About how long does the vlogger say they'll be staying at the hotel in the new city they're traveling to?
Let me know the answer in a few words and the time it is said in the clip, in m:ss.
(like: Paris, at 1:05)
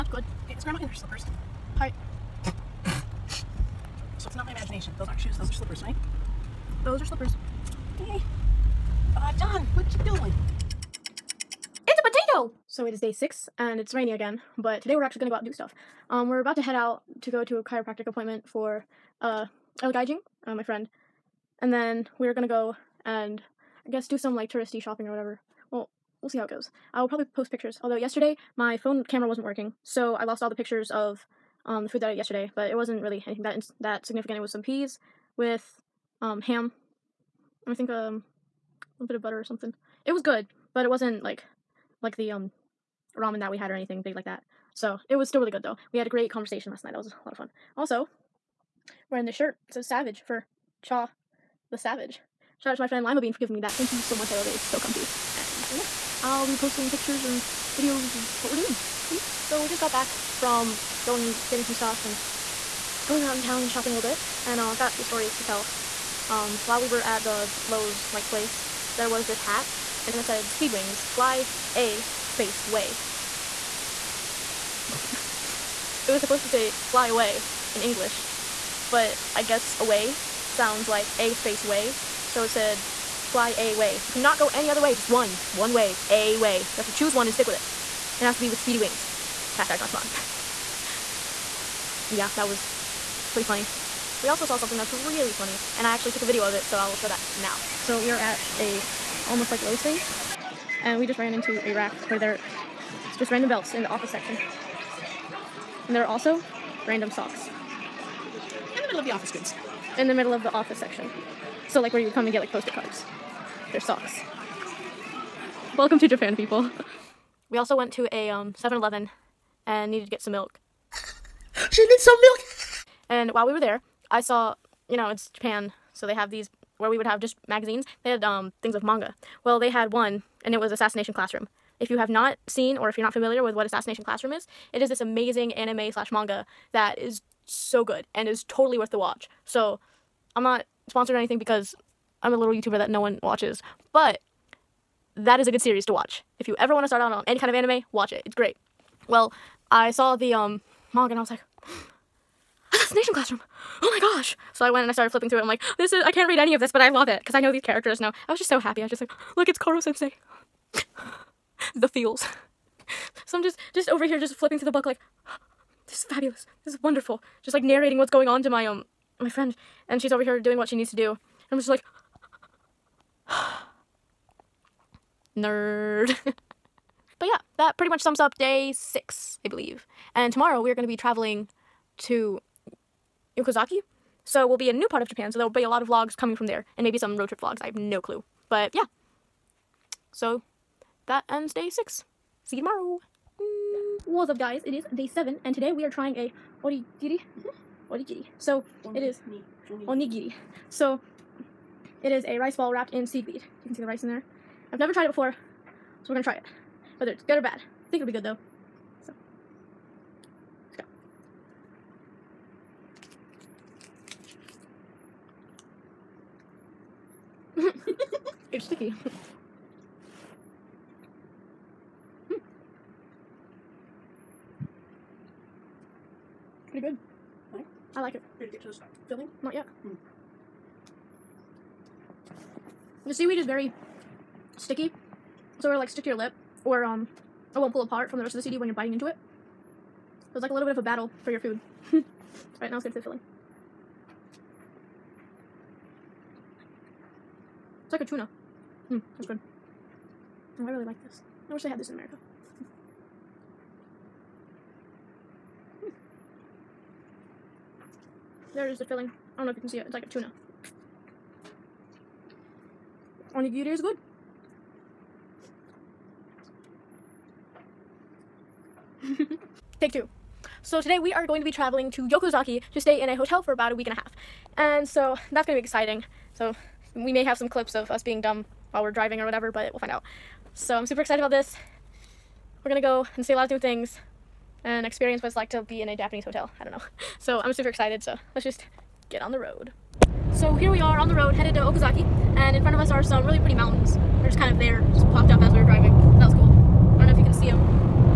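A week and a half, at 4:33.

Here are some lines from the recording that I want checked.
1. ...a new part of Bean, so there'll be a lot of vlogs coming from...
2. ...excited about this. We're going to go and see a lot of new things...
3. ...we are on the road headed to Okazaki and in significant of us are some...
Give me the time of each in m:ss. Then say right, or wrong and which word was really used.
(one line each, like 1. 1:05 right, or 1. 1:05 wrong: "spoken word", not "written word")
1. 3:04 wrong: "Japan", not "Bean"
2. 4:40 right
3. 4:50 wrong: "front", not "significant".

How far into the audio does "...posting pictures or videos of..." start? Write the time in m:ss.
0:56.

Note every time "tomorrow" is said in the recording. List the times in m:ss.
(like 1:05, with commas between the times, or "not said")
3:00, 3:12.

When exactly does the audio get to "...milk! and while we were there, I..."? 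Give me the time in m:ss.
2:02.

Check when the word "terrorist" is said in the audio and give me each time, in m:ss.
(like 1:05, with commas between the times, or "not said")
not said.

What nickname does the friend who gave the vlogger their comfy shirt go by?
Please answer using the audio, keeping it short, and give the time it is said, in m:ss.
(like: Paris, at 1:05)
Lima Bean, at 0:53.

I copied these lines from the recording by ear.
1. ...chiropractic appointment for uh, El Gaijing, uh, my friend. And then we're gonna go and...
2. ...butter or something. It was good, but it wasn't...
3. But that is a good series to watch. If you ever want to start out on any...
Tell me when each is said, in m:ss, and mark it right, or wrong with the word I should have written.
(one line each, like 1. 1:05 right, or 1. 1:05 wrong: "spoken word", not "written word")
1. 0:17 right
2. 0:39 right
3. 2:23 right.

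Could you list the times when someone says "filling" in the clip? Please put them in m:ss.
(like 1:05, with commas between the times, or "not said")
3:49, 4:03, 4:18.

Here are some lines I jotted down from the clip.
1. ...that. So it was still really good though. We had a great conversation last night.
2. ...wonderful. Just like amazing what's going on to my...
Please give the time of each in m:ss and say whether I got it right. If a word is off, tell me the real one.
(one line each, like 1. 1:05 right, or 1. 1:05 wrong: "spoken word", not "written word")
1. 0:44 right
2. 2:46 wrong: "narrating", not "amazing".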